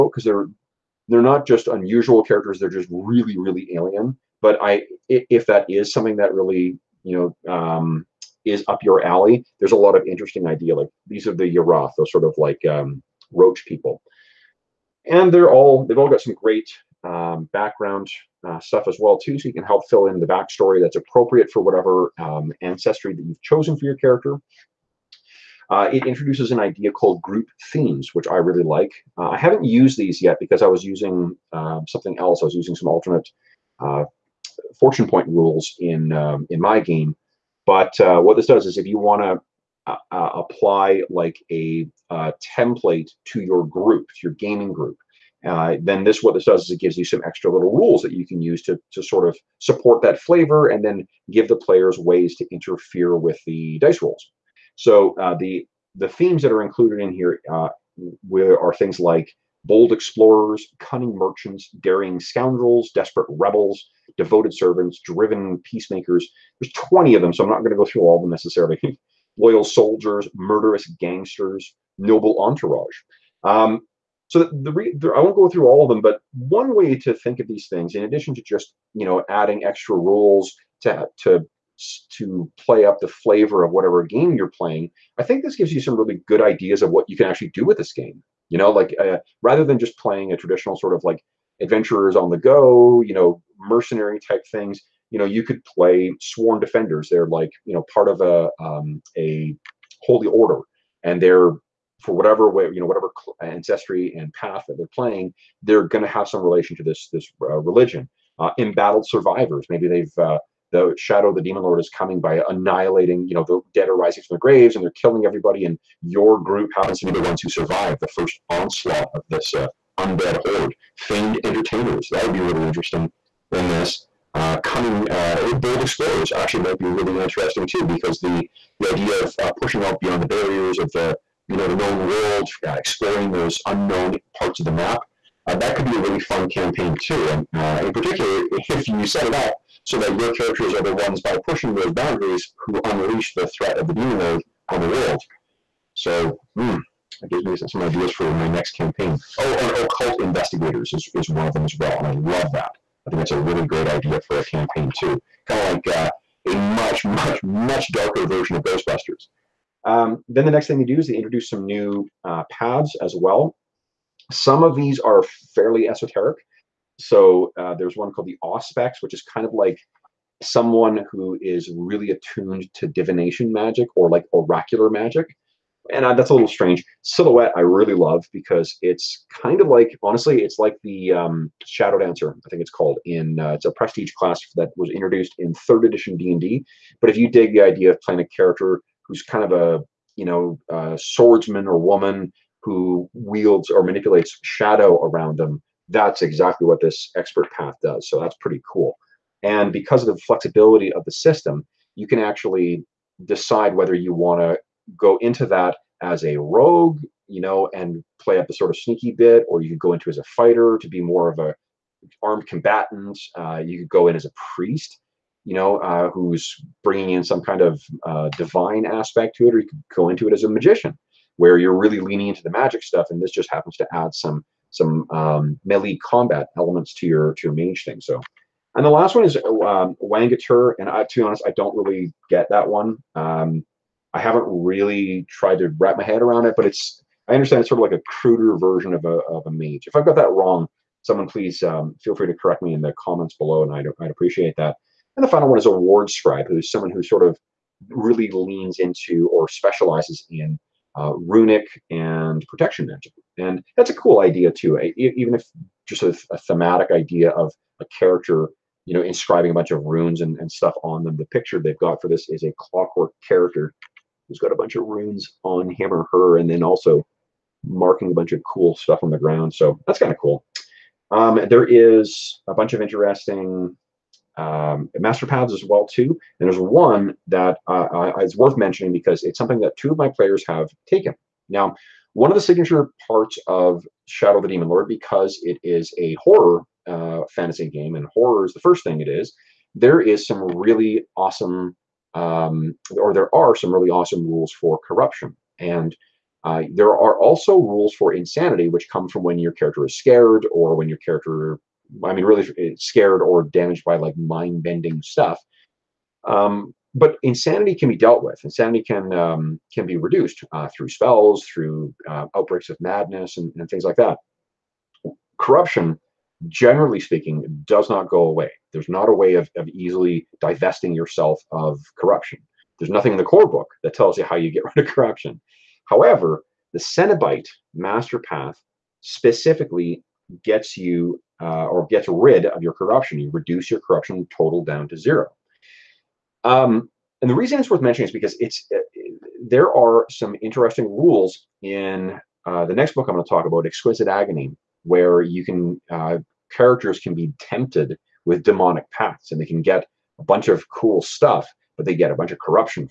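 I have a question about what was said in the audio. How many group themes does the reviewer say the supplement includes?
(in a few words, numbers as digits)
20.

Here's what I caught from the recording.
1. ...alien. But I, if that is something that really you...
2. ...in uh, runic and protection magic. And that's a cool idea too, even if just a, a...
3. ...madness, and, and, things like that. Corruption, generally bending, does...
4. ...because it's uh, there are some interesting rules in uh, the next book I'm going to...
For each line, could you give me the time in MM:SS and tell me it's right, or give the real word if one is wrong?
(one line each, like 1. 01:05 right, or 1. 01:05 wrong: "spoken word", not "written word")
1. 00:03 right
2. 04:10 right
3. 05:12 wrong: "speaking", not "bending"
4. 05:38 right.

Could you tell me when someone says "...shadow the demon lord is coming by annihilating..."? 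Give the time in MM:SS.
01:50.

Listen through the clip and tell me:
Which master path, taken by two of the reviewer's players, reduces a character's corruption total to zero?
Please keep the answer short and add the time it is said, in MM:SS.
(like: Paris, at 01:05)
Cenobite, at 05:26.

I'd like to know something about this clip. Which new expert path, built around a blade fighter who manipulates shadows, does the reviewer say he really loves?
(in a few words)
Silhouette.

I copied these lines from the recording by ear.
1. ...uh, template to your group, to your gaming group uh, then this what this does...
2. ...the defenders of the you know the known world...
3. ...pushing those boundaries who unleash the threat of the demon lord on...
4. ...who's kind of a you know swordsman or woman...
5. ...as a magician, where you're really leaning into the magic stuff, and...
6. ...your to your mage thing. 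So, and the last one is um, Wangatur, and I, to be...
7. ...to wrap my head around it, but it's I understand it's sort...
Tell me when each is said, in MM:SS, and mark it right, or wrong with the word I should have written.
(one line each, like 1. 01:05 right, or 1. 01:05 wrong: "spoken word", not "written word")
1. 00:42 right
2. 02:10 wrong: "barriers", not "defenders"
3. 02:21 right
4. 03:09 right
5. 03:40 right
6. 03:47 right
7. 03:55 right.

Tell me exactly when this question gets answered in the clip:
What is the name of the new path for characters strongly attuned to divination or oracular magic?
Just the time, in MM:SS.
02:48.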